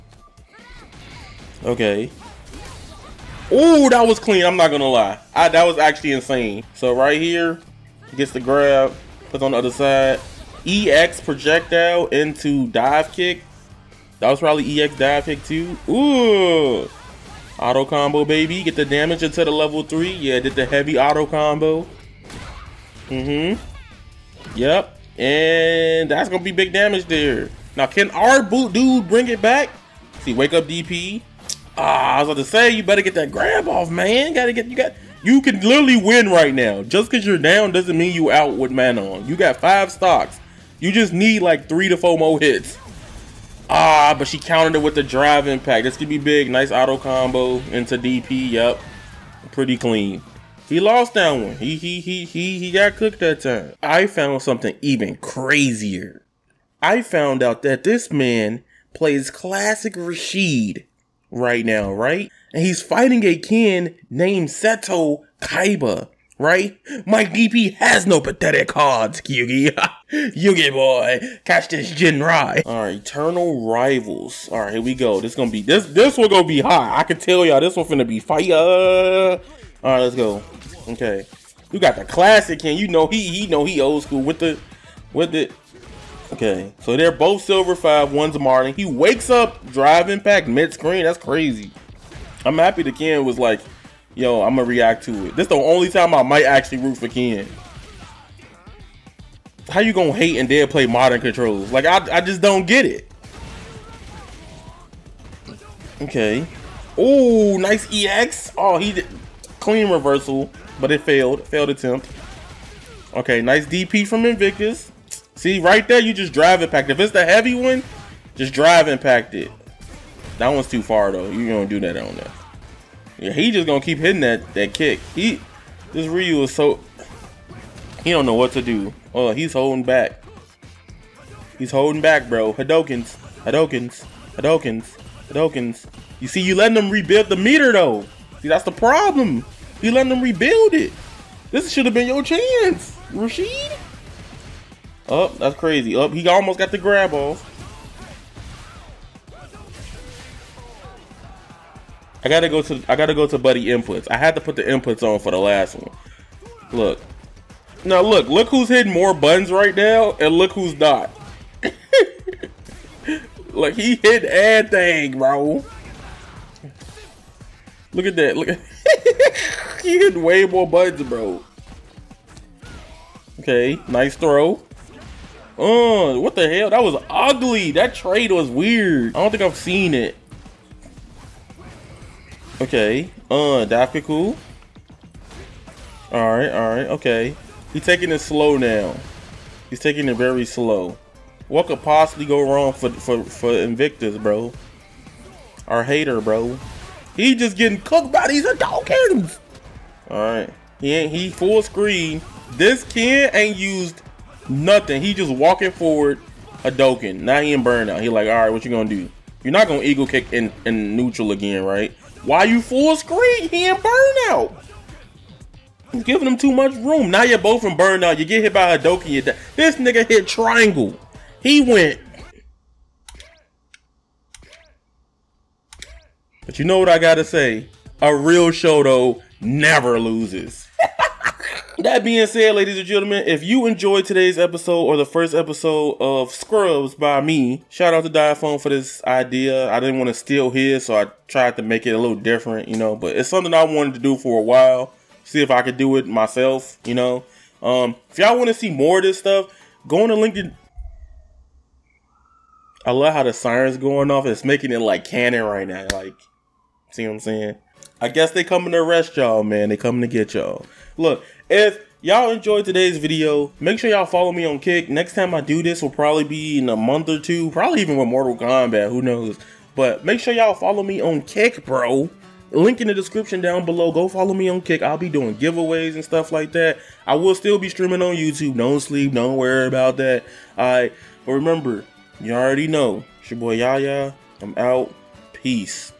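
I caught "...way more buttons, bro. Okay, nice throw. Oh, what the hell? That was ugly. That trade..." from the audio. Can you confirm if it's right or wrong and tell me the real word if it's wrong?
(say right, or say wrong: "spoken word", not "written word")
right.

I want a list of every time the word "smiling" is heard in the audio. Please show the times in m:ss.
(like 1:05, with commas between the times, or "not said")
not said.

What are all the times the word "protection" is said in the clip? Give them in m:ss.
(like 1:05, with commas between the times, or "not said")
not said.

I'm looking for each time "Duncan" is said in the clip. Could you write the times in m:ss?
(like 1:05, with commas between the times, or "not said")
not said.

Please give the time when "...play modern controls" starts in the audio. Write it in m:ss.
1:40.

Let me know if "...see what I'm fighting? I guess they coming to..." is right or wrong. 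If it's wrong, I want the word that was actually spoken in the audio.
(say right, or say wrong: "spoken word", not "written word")
wrong: "saying", not "fighting".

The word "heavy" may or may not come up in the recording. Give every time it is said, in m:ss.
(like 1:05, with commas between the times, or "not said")
0:20, 1:57.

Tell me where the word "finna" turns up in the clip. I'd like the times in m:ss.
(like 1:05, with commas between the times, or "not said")
1:17.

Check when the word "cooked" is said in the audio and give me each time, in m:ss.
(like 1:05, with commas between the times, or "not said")
0:52, 3:17.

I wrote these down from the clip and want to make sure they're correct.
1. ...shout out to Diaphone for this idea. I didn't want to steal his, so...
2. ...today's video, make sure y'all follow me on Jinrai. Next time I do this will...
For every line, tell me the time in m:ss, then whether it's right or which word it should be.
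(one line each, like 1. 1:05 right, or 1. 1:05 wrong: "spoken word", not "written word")
1. 3:57 right
2. 4:22 wrong: "Kick", not "Jinrai".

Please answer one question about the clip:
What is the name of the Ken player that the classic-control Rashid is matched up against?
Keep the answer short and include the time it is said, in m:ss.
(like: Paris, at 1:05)
Seto Kaiba, at 1:04.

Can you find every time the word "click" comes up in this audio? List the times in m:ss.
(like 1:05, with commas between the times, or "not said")
not said.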